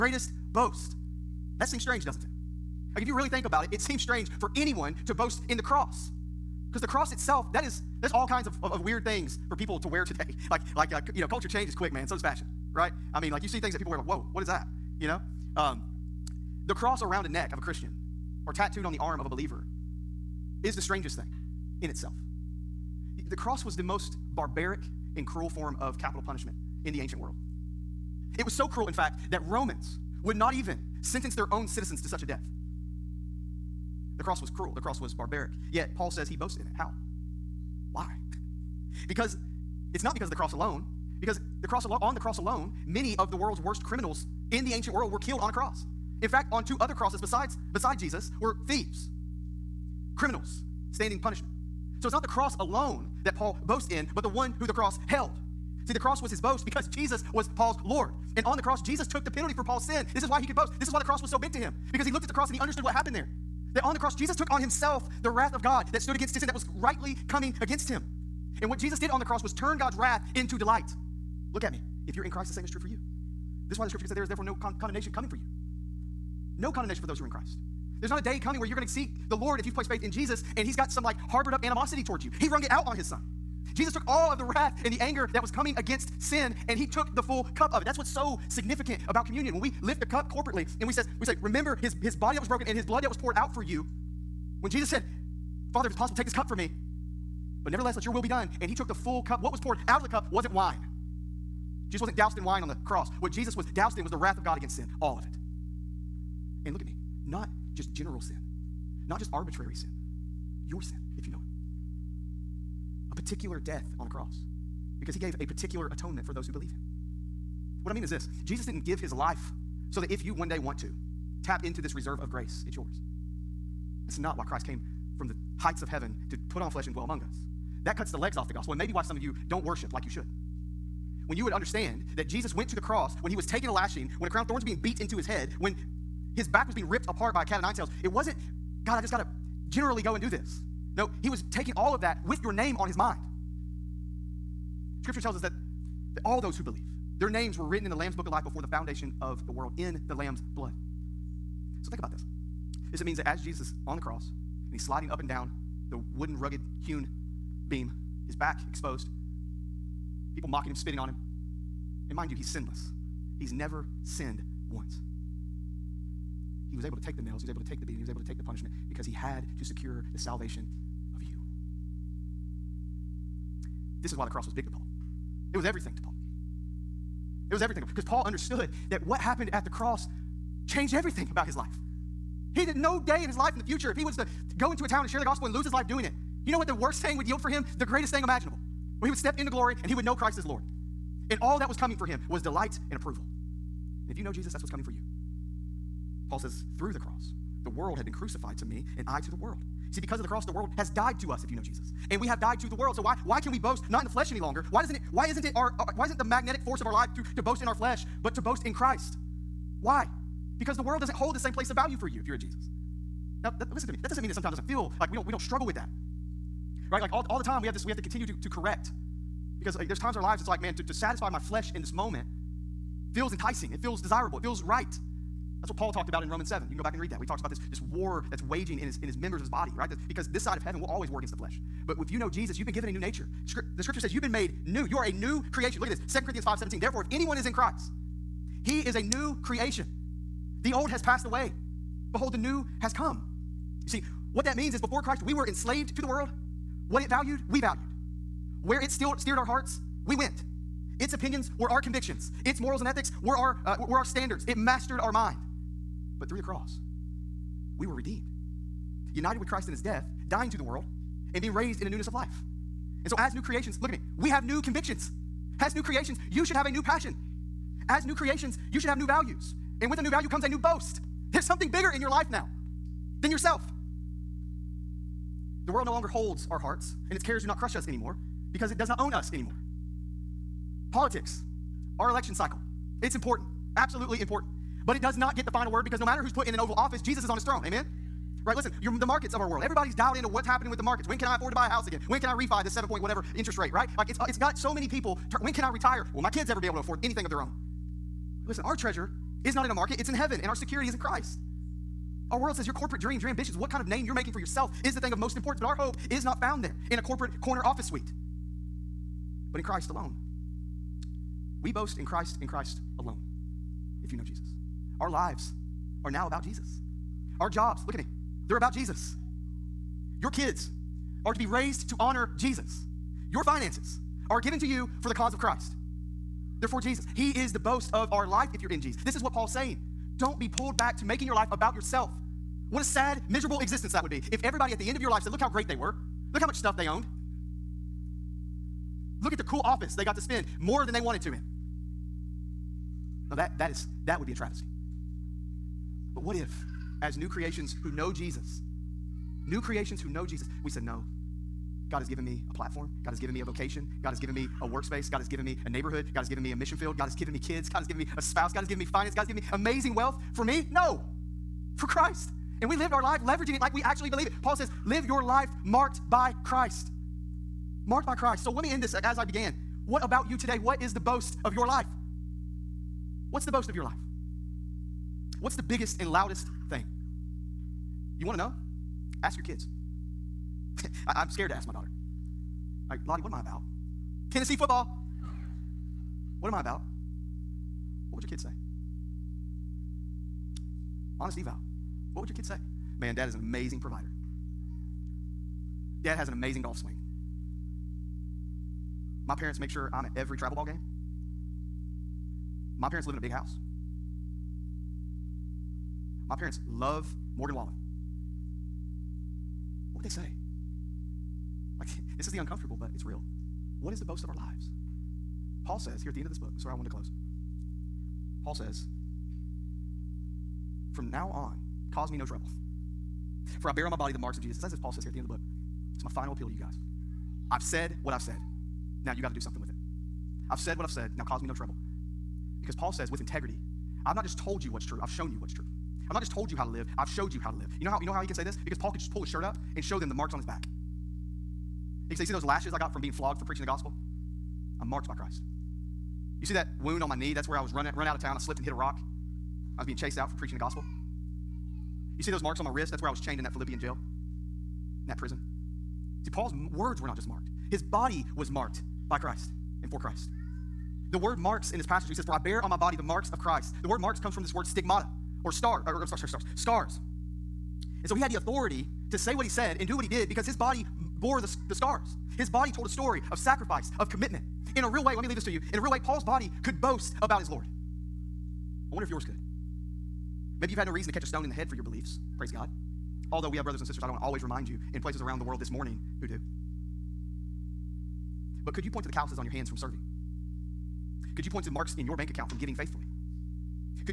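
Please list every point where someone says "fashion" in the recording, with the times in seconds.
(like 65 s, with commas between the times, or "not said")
12 s.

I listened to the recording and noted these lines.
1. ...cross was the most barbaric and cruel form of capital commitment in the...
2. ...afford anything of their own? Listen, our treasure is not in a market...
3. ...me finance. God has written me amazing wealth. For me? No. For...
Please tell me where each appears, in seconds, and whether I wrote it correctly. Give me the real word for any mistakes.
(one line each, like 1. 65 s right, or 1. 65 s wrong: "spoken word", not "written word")
1. 23 s wrong: "punishment", not "commitment"
2. 296 s right
3. 358 s wrong: "given", not "written".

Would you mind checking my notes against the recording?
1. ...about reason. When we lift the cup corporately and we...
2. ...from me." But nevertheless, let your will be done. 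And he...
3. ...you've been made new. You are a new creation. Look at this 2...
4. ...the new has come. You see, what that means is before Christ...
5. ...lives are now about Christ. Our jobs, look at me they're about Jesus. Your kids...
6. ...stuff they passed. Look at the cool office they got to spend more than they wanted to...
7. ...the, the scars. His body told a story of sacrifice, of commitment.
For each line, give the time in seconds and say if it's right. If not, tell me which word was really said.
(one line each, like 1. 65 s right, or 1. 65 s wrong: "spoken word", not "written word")
1. 89 s wrong: "communion", not "reason"
2. 96 s right
3. 234 s right
4. 242 s right
5. 315 s wrong: "Jesus", not "Christ"
6. 336 s wrong: "owned", not "passed"
7. 471 s right.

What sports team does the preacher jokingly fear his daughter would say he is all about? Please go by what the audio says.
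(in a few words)
Tennessee football.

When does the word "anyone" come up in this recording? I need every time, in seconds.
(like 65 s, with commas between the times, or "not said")
4 s, 237 s.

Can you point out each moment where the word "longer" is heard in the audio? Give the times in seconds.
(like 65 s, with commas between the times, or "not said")
204 s, 275 s.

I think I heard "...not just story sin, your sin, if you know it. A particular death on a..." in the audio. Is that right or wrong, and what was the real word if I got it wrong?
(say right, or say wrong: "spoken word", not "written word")
wrong: "arbitrary", not "story".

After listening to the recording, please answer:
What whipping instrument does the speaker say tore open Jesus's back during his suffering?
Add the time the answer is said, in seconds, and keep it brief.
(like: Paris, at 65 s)
Cat of nine tails, at 137 s.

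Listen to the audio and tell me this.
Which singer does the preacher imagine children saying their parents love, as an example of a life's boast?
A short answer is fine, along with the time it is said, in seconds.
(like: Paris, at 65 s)
Morgan Wallen, at 407 s.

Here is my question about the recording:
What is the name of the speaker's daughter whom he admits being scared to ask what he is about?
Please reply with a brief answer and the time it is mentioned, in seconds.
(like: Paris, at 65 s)
Lottie, at 383 s.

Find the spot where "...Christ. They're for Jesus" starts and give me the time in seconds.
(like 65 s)
325 s.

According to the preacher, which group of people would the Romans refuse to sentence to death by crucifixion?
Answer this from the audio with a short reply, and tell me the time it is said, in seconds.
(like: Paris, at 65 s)
Their own citizens, at 31 s.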